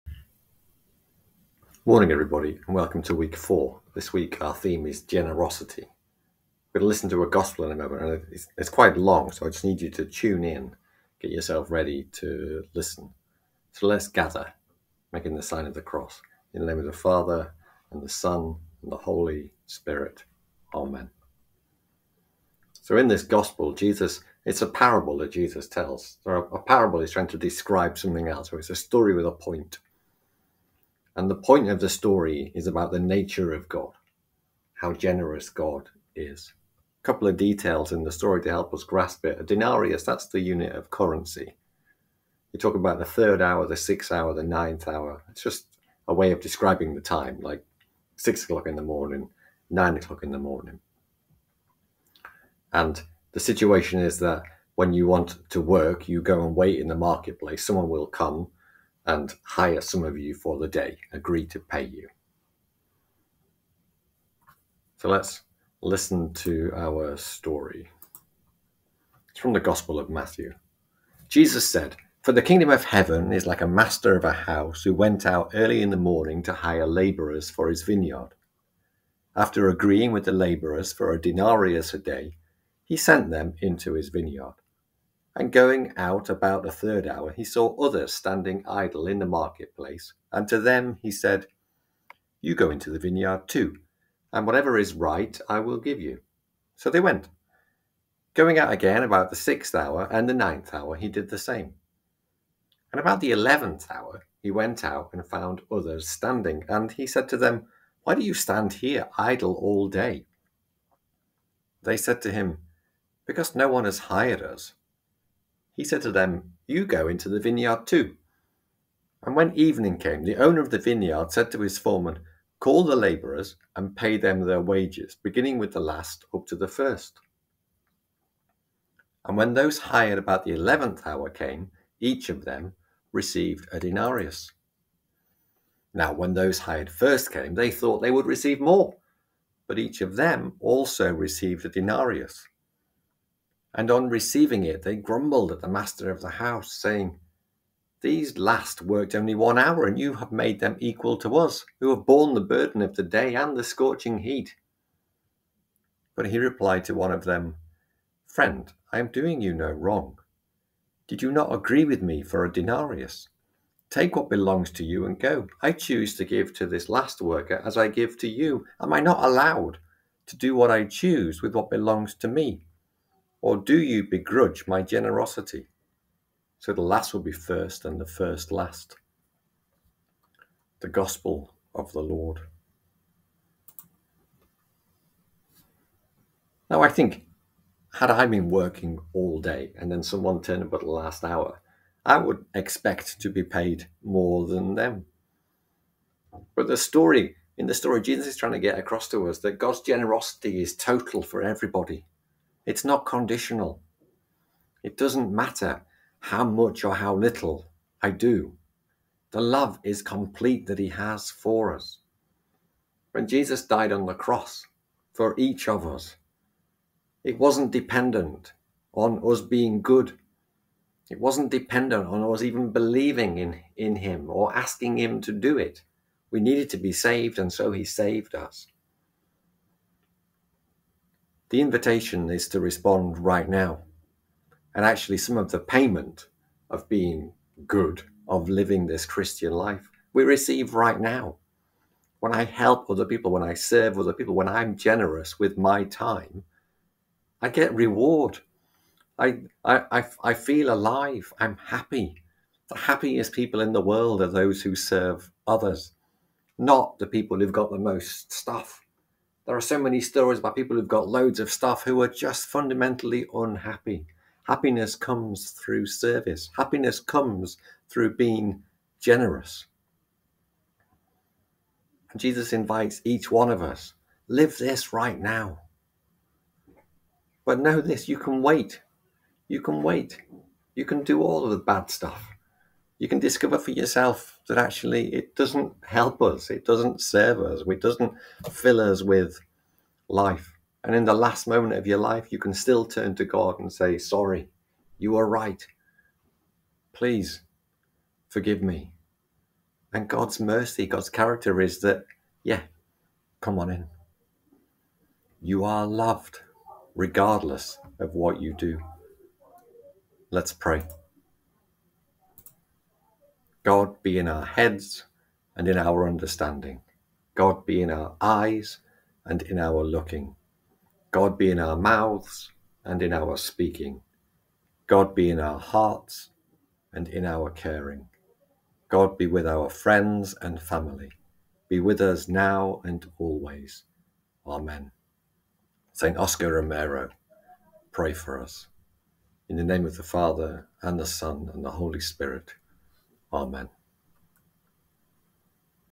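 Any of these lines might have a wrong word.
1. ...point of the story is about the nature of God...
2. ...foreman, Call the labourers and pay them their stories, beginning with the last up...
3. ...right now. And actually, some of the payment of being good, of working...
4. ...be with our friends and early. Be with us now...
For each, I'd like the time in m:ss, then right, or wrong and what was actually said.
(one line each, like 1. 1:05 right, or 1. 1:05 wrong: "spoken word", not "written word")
1. 0:31 right
2. 2:01 wrong: "wages", not "stories"
3. 3:53 wrong: "living", not "working"
4. 5:29 wrong: "family", not "early".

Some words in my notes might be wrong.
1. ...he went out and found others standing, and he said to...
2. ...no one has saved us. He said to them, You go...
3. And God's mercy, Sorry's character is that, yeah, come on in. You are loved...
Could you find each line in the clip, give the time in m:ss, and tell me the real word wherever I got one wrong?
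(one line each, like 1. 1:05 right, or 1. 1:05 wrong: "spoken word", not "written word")
1. 1:44 right
2. 1:53 wrong: "hired", not "saved"
3. 4:59 wrong: "God", not "Sorry".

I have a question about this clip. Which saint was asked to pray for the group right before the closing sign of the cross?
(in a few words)
St. Oscar Romero.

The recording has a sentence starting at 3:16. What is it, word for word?
But the story, in the story, Jesus is trying to get across to us that God's generosity is total for everybody.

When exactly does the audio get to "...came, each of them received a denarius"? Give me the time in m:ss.
2:11.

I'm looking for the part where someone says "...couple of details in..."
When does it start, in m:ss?
0:37.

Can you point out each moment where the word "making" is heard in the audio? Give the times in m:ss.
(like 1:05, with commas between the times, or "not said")
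0:15.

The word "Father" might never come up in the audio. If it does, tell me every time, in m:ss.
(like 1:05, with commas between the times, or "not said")
0:16, 5:40.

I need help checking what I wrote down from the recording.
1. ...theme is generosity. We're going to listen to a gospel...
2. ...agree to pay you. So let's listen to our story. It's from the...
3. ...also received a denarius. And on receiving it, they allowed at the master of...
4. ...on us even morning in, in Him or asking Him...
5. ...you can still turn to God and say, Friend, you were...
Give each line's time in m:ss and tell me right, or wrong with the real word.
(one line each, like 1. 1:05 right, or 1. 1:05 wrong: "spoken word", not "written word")
1. 0:04 right
2. 1:01 right
3. 2:20 wrong: "grumbled", not "allowed"
4. 3:42 wrong: "believing", not "morning"
5. 4:52 wrong: "Sorry", not "Friend".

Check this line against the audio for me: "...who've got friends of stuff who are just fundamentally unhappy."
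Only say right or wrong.
wrong.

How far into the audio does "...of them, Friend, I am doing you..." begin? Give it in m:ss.
2:37.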